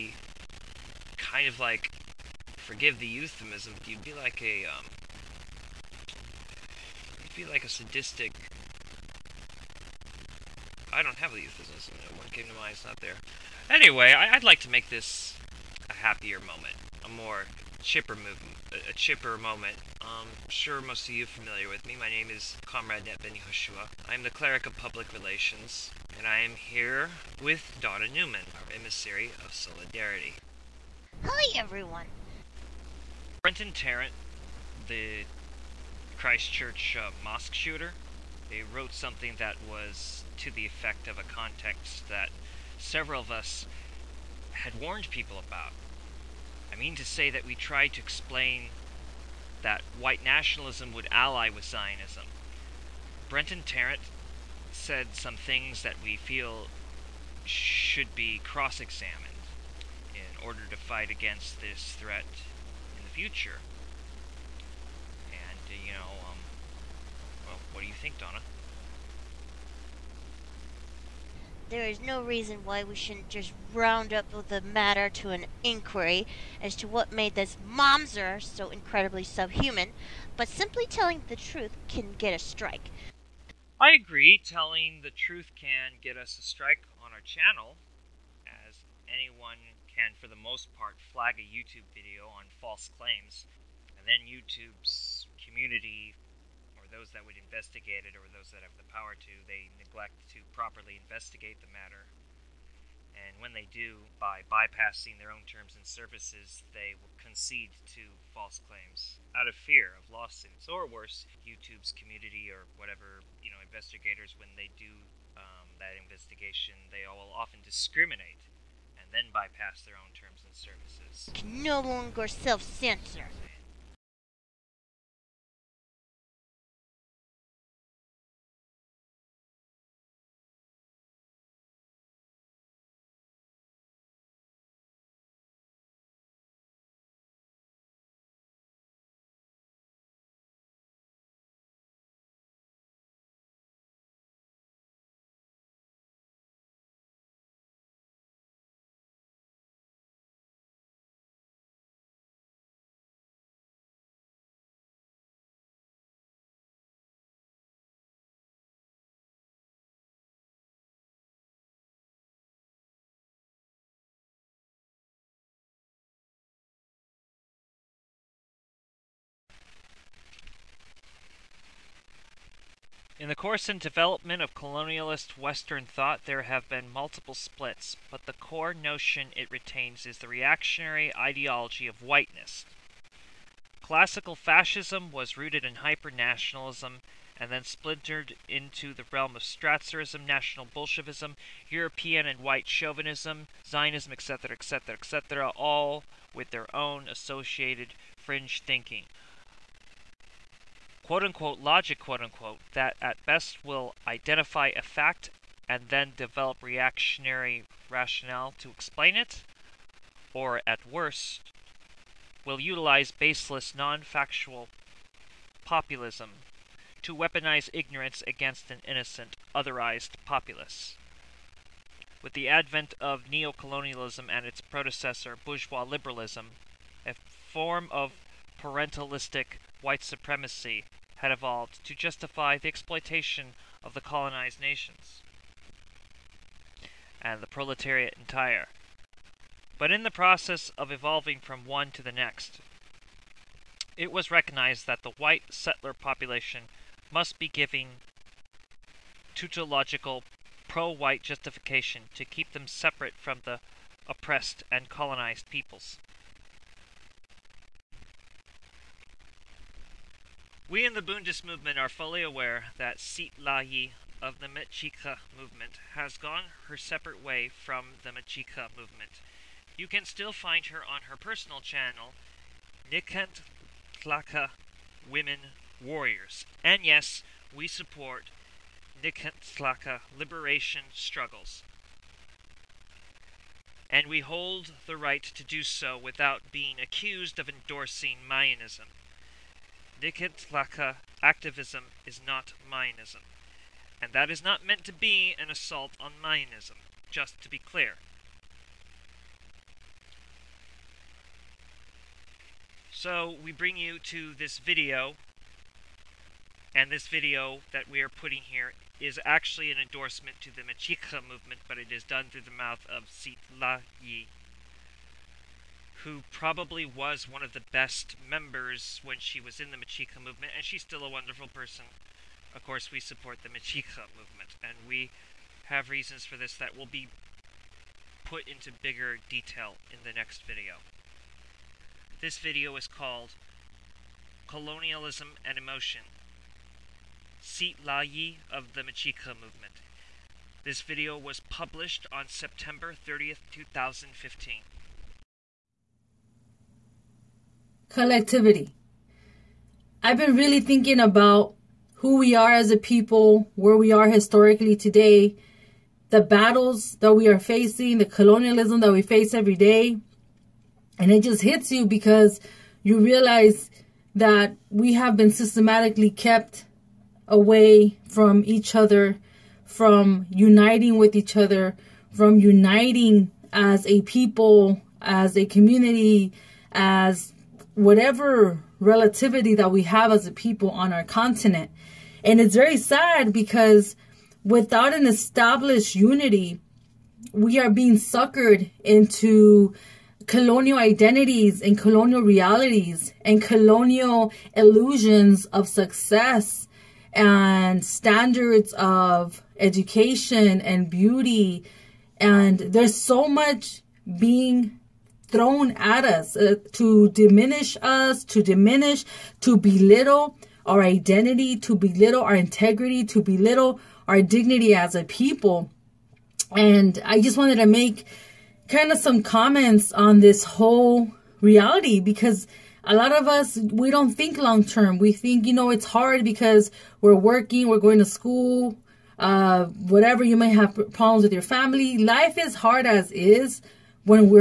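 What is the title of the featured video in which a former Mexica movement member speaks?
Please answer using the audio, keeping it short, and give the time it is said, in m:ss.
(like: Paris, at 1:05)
Colonialism and Emotion, at 5:34.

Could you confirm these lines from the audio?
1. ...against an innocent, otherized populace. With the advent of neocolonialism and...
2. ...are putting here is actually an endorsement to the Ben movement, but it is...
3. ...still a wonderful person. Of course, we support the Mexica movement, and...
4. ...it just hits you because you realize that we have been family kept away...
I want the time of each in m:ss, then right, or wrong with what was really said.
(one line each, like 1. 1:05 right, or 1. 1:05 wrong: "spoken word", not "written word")
1. 3:38 right
2. 5:08 wrong: "Mexica", not "Ben"
3. 5:20 right
4. 6:01 wrong: "systematically", not "family".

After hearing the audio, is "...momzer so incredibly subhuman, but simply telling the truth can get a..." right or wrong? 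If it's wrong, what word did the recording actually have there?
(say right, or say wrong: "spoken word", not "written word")
right.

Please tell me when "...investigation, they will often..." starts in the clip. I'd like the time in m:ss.
1:55.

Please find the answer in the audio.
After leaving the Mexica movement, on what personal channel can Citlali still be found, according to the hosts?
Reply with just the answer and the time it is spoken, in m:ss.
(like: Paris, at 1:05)
Nican Tlaca Women Warriors, at 4:32.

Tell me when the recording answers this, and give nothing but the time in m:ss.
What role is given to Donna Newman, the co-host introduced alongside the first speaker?
0:28.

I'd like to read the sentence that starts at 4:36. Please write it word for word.
And yes, we support Tlaca liberation struggles.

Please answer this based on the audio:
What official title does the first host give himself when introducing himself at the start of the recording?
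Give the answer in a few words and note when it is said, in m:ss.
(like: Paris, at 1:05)
Cleric of public relations, at 0:24.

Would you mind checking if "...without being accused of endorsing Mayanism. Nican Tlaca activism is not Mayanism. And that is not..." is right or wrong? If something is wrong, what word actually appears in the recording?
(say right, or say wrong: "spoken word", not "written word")
right.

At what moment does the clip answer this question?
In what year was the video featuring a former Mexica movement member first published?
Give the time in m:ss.
5:43.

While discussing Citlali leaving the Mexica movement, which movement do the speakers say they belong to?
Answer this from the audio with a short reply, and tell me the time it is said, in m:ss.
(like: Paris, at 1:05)
Bundist, at 4:21.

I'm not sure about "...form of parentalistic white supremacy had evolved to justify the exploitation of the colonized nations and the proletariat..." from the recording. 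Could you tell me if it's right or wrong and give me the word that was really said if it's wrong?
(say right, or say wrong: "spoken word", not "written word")
right.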